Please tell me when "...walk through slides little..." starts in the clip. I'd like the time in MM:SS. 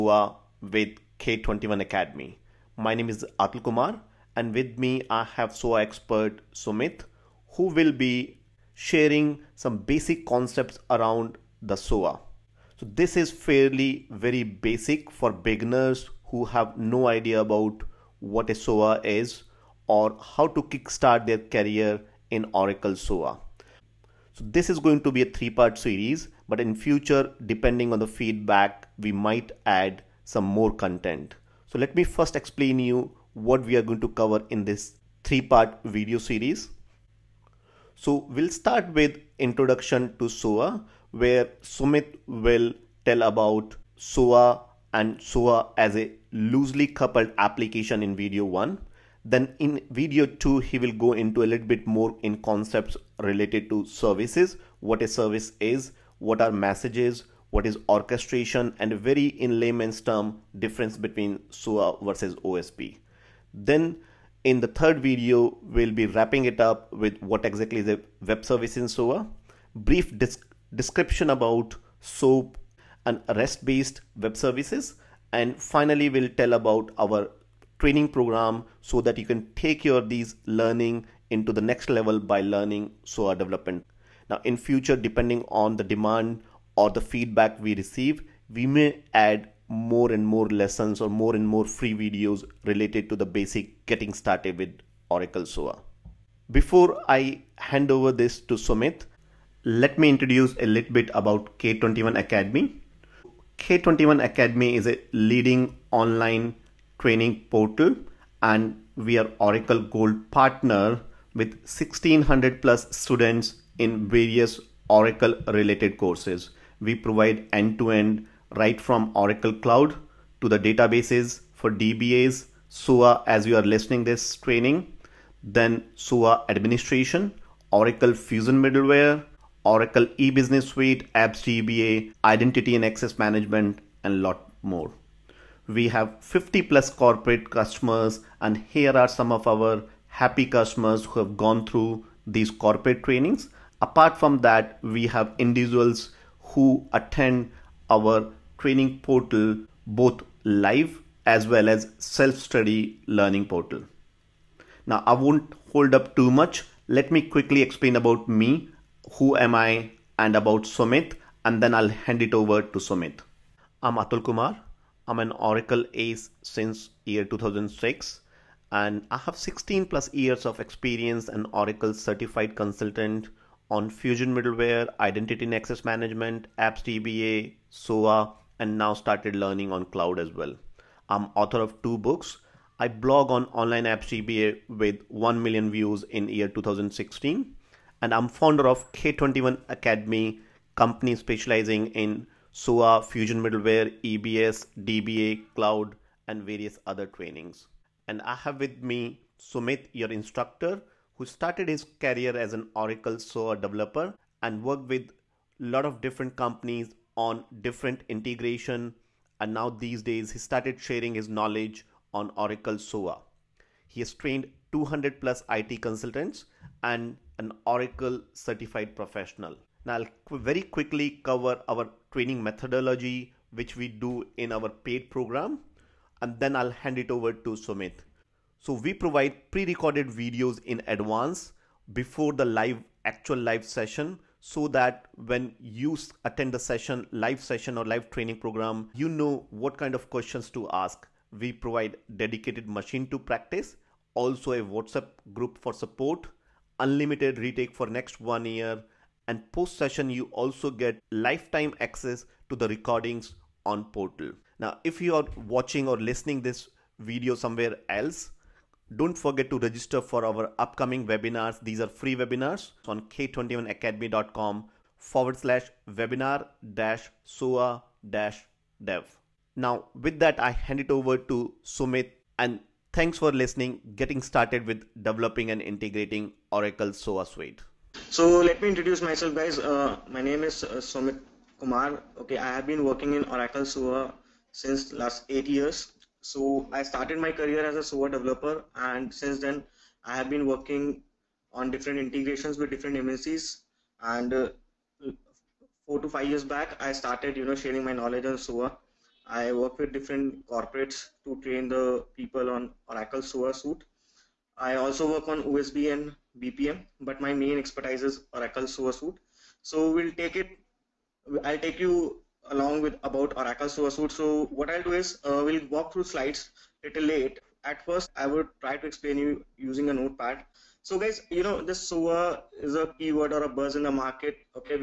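05:15.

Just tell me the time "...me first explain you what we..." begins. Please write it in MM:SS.
00:31.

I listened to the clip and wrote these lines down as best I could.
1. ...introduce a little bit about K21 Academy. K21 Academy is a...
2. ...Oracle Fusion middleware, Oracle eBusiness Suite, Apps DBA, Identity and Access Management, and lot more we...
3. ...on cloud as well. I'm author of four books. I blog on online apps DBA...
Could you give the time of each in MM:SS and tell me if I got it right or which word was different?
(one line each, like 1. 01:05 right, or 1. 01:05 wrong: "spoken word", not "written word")
1. 01:40 right
2. 02:07 right
3. 02:59 wrong: "two", not "four".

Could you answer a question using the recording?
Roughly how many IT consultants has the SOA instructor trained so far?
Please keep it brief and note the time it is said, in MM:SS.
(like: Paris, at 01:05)
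200+, at 03:34.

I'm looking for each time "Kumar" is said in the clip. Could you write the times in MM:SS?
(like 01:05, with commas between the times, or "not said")
00:03, 02:44, 04:41.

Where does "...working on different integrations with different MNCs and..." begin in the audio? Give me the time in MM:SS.
04:50.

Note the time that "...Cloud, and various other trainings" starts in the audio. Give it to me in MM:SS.
03:15.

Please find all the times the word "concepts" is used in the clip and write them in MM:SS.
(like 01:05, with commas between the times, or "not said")
00:10, 00:52.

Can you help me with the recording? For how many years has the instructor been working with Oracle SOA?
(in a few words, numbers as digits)
8 years.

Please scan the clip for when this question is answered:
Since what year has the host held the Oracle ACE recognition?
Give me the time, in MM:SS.
02:47.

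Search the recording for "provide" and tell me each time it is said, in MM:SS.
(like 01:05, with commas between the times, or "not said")
01:56, 03:48, 04:01.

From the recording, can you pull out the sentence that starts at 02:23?
Apart from that, we have individuals who attend our training portal both live as well as self-study learning portal.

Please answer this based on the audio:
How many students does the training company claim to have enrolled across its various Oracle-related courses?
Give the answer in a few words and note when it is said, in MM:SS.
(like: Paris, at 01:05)
1600+, at 01:51.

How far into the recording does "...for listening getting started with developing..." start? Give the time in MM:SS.
04:33.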